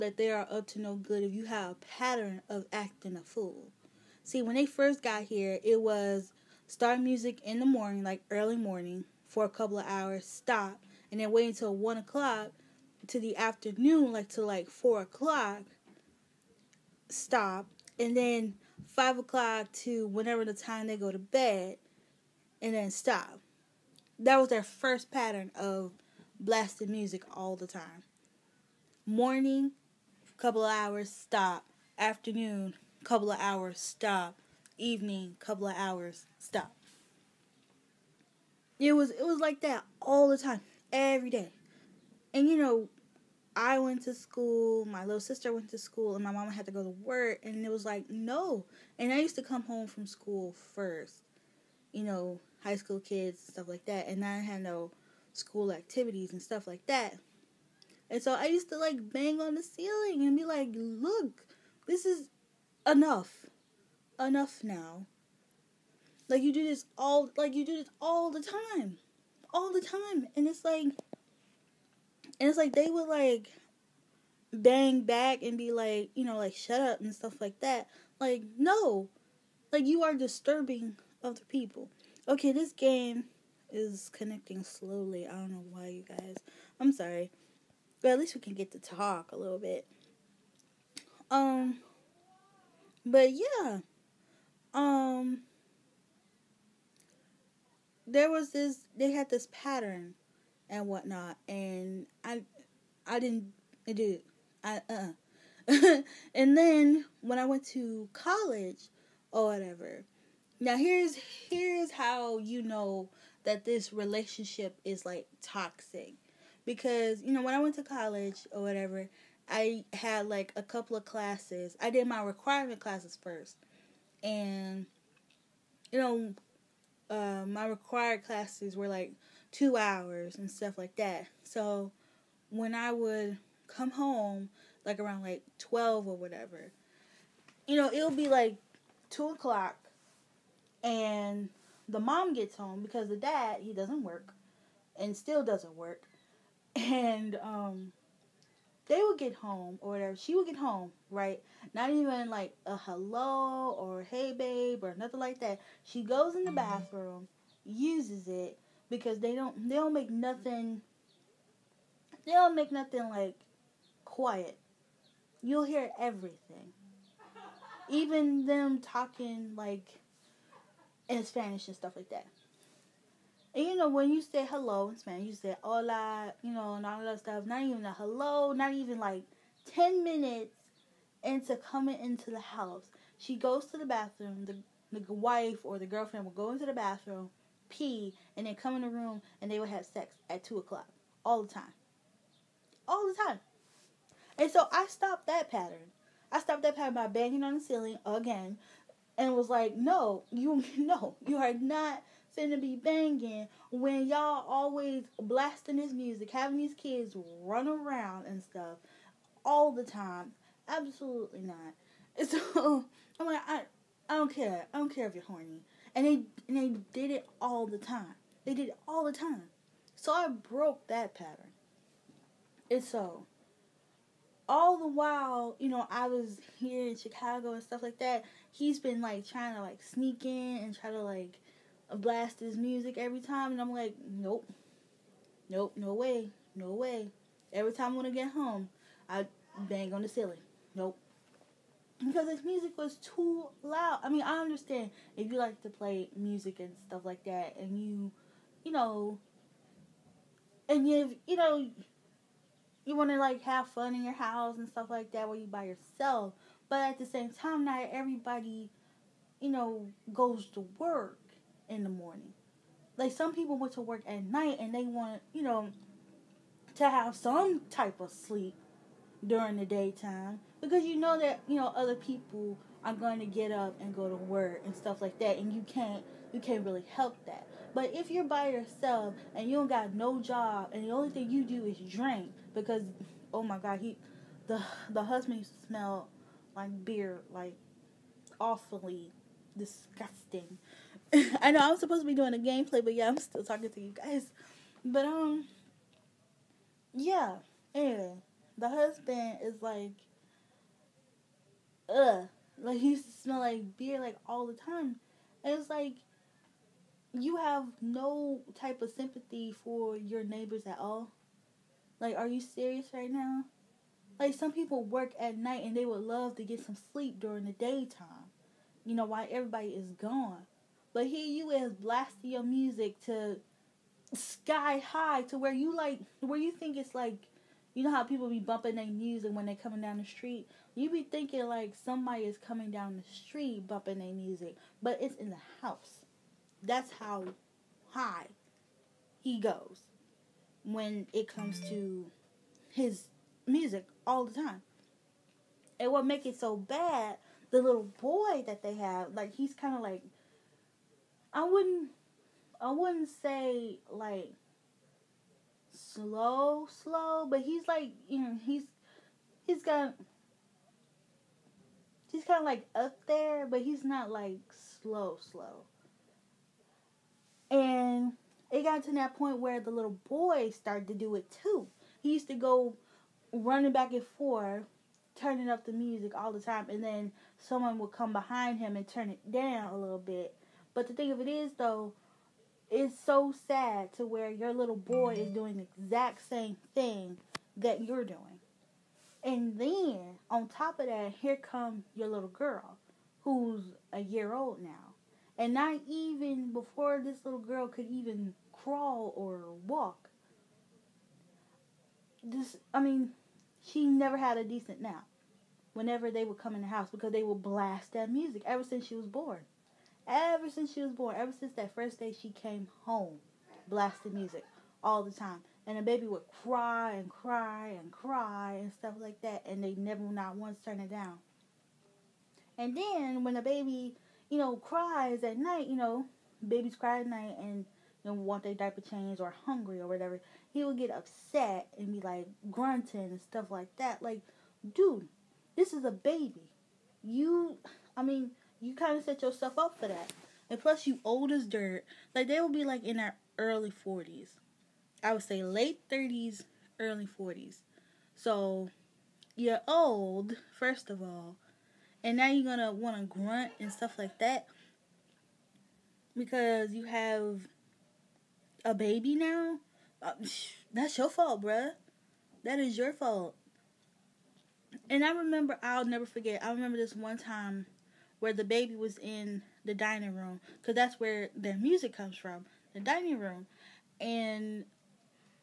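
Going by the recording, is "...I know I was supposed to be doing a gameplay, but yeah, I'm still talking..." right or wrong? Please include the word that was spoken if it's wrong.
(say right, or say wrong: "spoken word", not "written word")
right.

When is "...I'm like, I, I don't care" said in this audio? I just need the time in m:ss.
3:33.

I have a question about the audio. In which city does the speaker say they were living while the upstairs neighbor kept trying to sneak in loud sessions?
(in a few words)
Chicago.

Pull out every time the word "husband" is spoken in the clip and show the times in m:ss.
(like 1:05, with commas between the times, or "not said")
4:45, 4:58.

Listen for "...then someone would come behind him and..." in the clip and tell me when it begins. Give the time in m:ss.
6:16.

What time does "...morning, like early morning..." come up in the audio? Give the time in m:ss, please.
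0:07.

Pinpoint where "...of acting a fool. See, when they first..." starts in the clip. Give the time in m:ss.
0:02.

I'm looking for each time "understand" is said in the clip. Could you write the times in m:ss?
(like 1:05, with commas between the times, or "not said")
4:04.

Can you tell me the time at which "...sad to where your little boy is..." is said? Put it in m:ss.
6:23.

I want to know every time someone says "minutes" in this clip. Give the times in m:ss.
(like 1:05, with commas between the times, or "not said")
3:00.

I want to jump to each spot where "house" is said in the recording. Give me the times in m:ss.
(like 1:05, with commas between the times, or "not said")
3:02, 4:14, 5:35, 6:46.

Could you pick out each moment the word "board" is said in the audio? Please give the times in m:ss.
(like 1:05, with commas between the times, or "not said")
not said.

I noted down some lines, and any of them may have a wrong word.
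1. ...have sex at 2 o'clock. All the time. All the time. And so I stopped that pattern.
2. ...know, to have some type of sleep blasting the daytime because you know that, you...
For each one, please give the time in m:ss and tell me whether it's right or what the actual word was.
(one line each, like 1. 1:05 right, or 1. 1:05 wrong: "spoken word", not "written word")
1. 3:09 right
2. 4:25 wrong: "during", not "blasting".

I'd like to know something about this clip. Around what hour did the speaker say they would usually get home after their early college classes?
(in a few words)
12.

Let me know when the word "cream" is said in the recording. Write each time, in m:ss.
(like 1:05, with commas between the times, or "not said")
not said.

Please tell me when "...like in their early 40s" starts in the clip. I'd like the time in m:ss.
7:22.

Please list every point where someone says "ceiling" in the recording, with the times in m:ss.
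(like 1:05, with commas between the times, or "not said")
0:59, 3:17, 4:00.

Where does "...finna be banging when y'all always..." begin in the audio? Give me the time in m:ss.
3:22.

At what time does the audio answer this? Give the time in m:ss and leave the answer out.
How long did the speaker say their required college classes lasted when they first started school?
2:09.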